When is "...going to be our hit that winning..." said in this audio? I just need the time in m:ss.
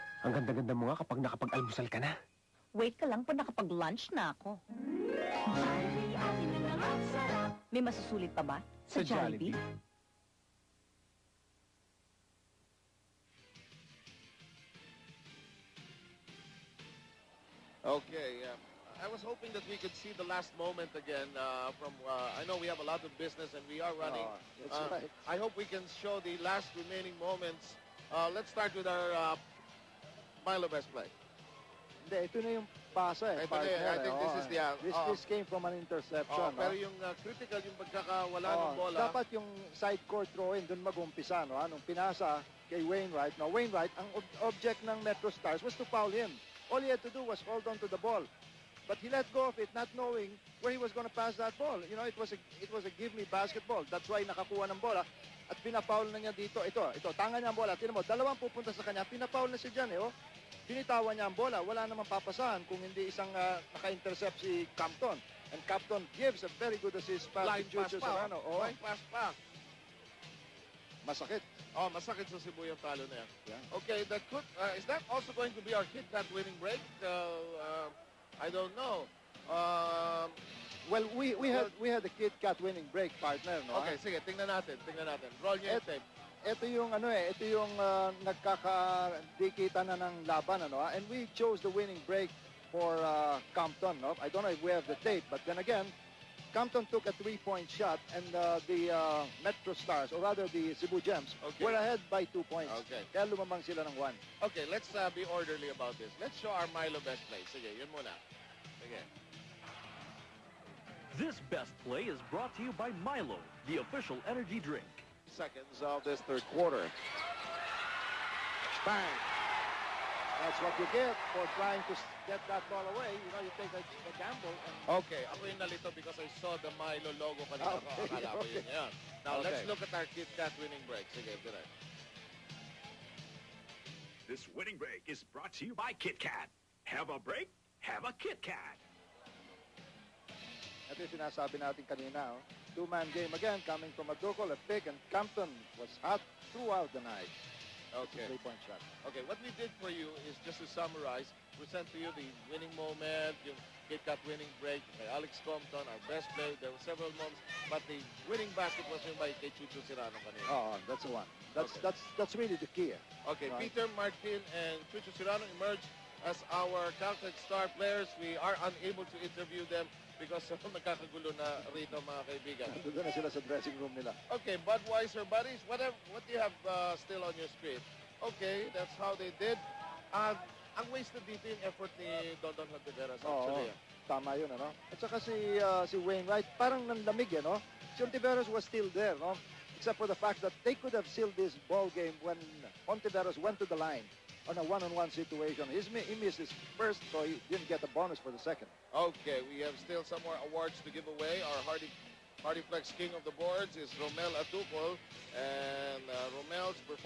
1:15.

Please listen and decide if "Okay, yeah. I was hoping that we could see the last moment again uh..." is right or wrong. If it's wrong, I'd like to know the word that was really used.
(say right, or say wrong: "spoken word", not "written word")
right.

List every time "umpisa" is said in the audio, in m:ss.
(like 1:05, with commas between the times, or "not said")
0:40.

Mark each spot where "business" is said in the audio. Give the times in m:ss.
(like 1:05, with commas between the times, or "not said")
0:23.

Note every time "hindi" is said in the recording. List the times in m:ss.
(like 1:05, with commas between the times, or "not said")
0:32, 1:02.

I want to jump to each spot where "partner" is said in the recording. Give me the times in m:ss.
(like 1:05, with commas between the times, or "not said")
0:33, 1:23.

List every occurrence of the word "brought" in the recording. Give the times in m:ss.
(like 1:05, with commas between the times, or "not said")
1:52, 2:15.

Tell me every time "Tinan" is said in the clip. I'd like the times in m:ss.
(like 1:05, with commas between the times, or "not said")
0:57.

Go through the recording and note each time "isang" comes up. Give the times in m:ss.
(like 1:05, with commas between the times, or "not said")
1:03.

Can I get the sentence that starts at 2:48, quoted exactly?
We are unable to interview them because uh, nagkakagulo na rito mga kaibigan.